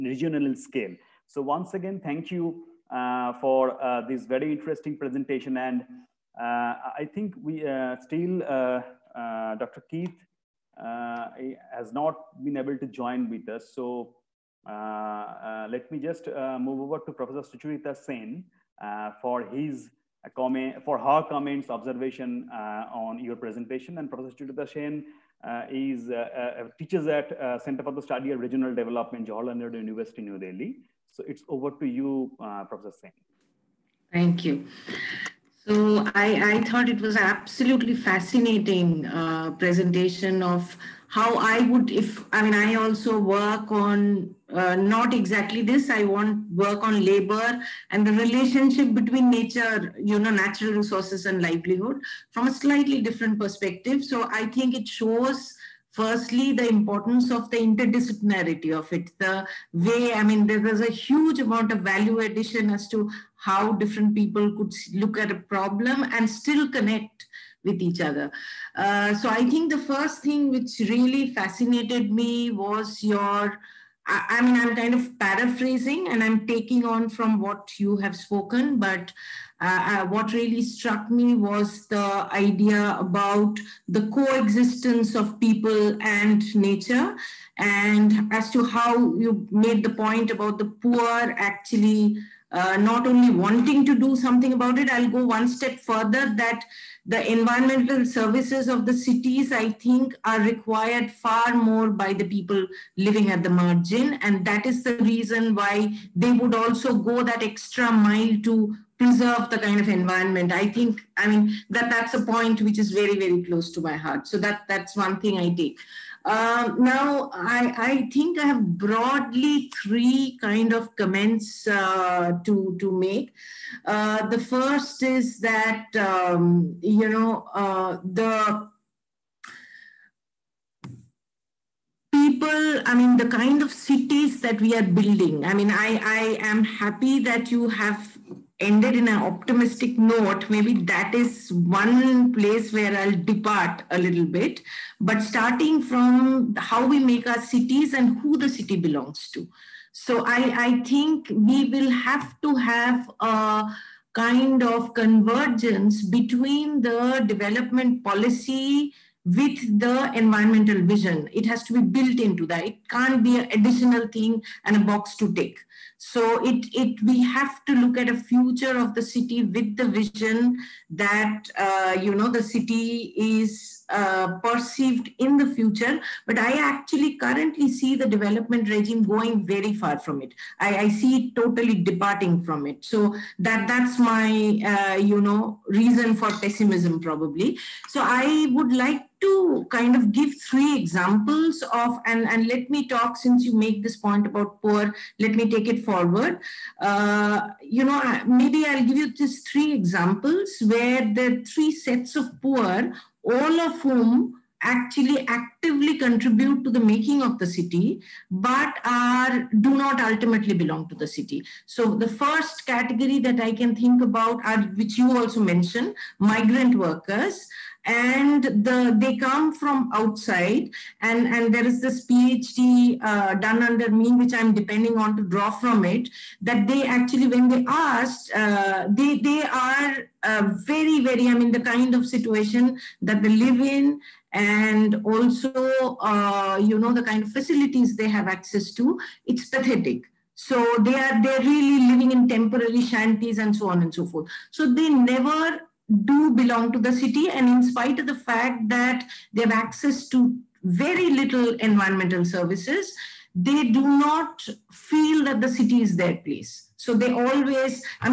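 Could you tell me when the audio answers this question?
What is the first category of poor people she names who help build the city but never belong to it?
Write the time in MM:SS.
03:36.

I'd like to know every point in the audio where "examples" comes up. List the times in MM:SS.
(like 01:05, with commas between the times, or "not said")
03:10, 03:19.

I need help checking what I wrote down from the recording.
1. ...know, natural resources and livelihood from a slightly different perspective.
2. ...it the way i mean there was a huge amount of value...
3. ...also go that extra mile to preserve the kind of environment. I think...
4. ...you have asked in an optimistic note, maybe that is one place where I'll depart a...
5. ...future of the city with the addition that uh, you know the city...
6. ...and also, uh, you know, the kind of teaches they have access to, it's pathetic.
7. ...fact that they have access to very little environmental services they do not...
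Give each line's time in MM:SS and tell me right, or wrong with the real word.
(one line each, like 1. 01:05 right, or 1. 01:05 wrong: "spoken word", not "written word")
1. 00:50 right
2. 00:58 right
3. 01:46 right
4. 02:17 wrong: "ended", not "asked"
5. 02:48 wrong: "vision", not "addition"
6. 03:54 wrong: "facilities", not "teaches"
7. 04:08 right.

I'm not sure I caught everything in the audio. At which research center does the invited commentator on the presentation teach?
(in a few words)
Center for the Study of Regional Development.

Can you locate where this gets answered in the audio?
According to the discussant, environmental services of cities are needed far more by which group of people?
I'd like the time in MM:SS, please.
01:42.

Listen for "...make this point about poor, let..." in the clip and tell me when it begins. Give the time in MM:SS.
03:13.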